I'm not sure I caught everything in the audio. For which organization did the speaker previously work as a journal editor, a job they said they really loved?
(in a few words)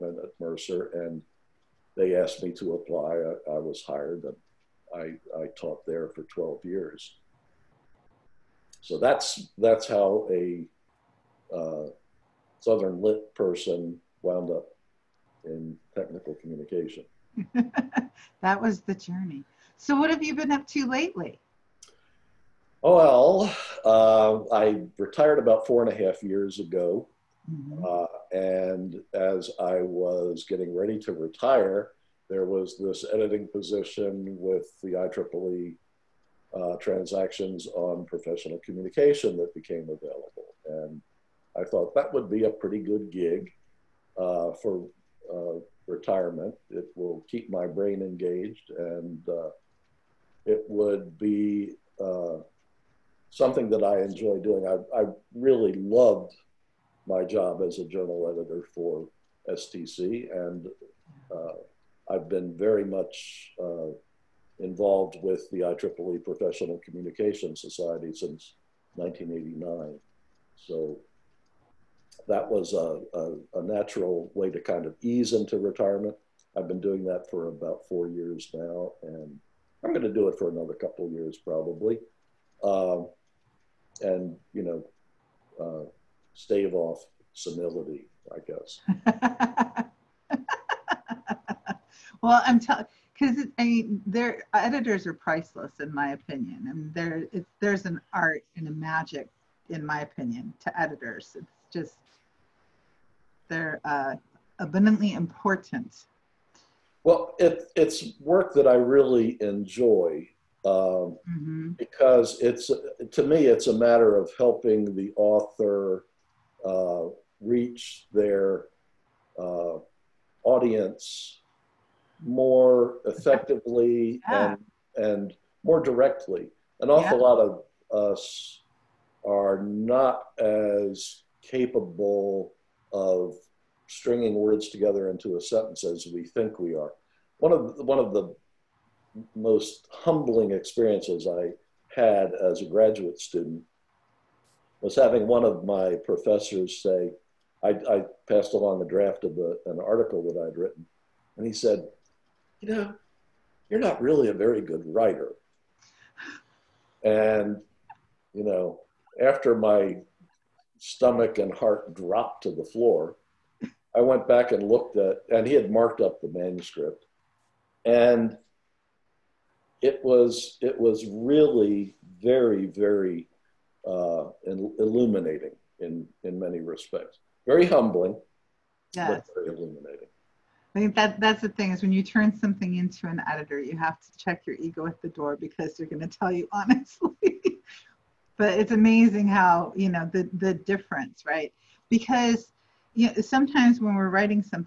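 STC.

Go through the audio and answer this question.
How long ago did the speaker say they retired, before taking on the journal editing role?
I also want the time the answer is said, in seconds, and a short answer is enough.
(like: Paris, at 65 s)
4 and a half years, at 25 s.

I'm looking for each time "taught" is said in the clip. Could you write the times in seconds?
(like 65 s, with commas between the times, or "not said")
5 s.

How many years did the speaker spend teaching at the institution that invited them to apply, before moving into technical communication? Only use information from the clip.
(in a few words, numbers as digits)
12 years.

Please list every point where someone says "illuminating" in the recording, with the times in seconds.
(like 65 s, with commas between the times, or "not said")
174 s, 179 s.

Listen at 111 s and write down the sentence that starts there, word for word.
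because it's to me it's a matter of helping the author uh, reach their uh, audience more effectively yeah.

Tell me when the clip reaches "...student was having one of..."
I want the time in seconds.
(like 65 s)
143 s.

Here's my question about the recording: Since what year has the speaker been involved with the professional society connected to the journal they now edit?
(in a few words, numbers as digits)
1989.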